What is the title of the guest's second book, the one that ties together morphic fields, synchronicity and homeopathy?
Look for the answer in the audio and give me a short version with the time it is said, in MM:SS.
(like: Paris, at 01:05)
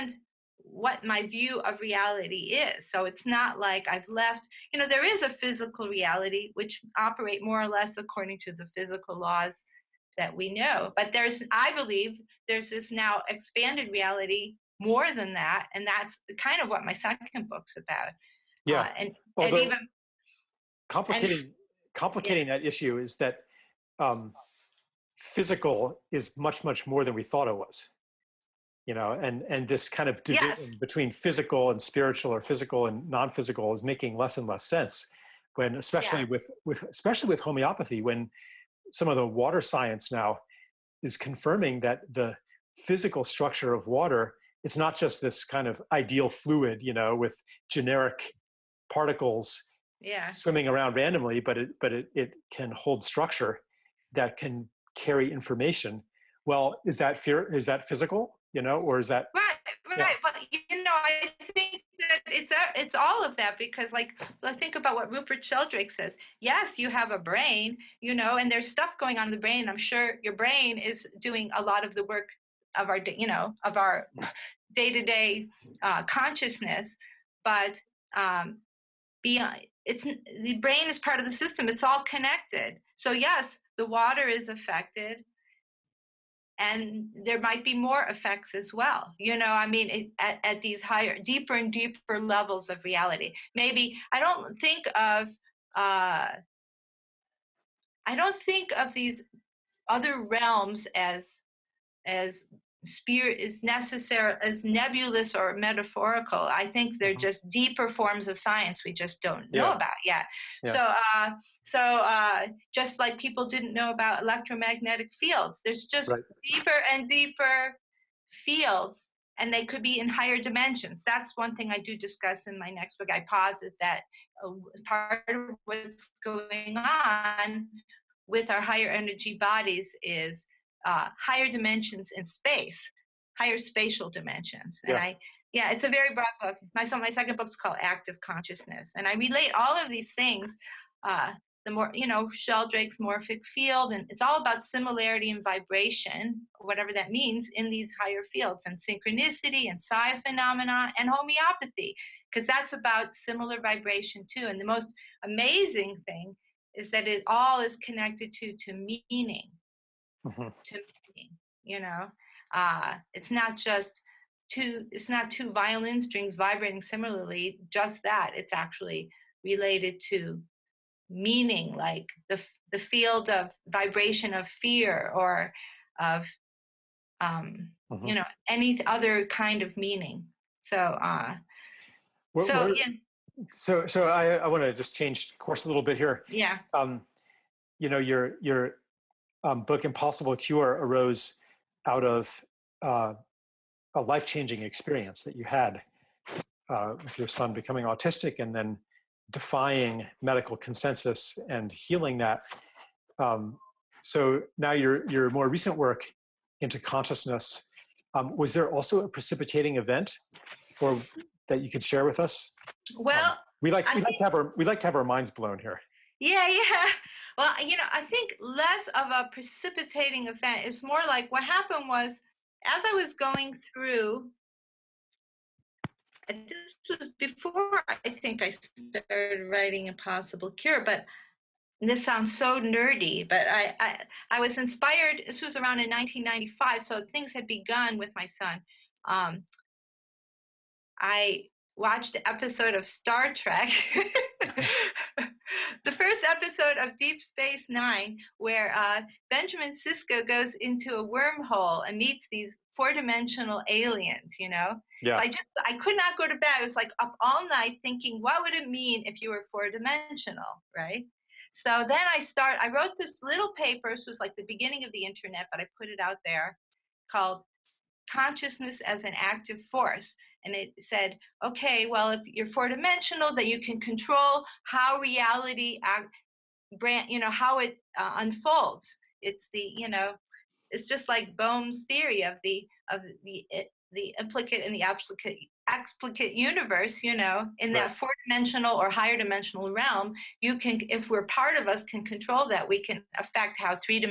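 Active Consciousness, at 02:17.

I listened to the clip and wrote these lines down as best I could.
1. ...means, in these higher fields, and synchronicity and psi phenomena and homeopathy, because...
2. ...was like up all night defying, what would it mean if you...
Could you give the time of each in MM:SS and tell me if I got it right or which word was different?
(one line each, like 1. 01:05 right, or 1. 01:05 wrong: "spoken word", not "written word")
1. 02:27 right
2. 04:16 wrong: "thinking", not "defying".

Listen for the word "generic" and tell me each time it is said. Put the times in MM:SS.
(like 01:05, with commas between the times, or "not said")
00:47.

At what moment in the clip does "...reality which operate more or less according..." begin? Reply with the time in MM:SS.
00:05.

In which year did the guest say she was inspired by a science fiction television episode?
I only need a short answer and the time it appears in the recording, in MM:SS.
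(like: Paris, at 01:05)
1995, at 03:55.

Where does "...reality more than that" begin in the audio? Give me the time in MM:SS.
00:13.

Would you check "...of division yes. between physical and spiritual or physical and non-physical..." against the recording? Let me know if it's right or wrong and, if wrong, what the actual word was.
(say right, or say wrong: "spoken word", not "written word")
right.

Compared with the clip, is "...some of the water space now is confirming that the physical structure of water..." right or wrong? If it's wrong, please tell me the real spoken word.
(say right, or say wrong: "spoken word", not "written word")
wrong: "science", not "space".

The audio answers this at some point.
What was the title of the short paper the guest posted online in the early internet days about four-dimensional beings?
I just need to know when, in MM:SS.
04:28.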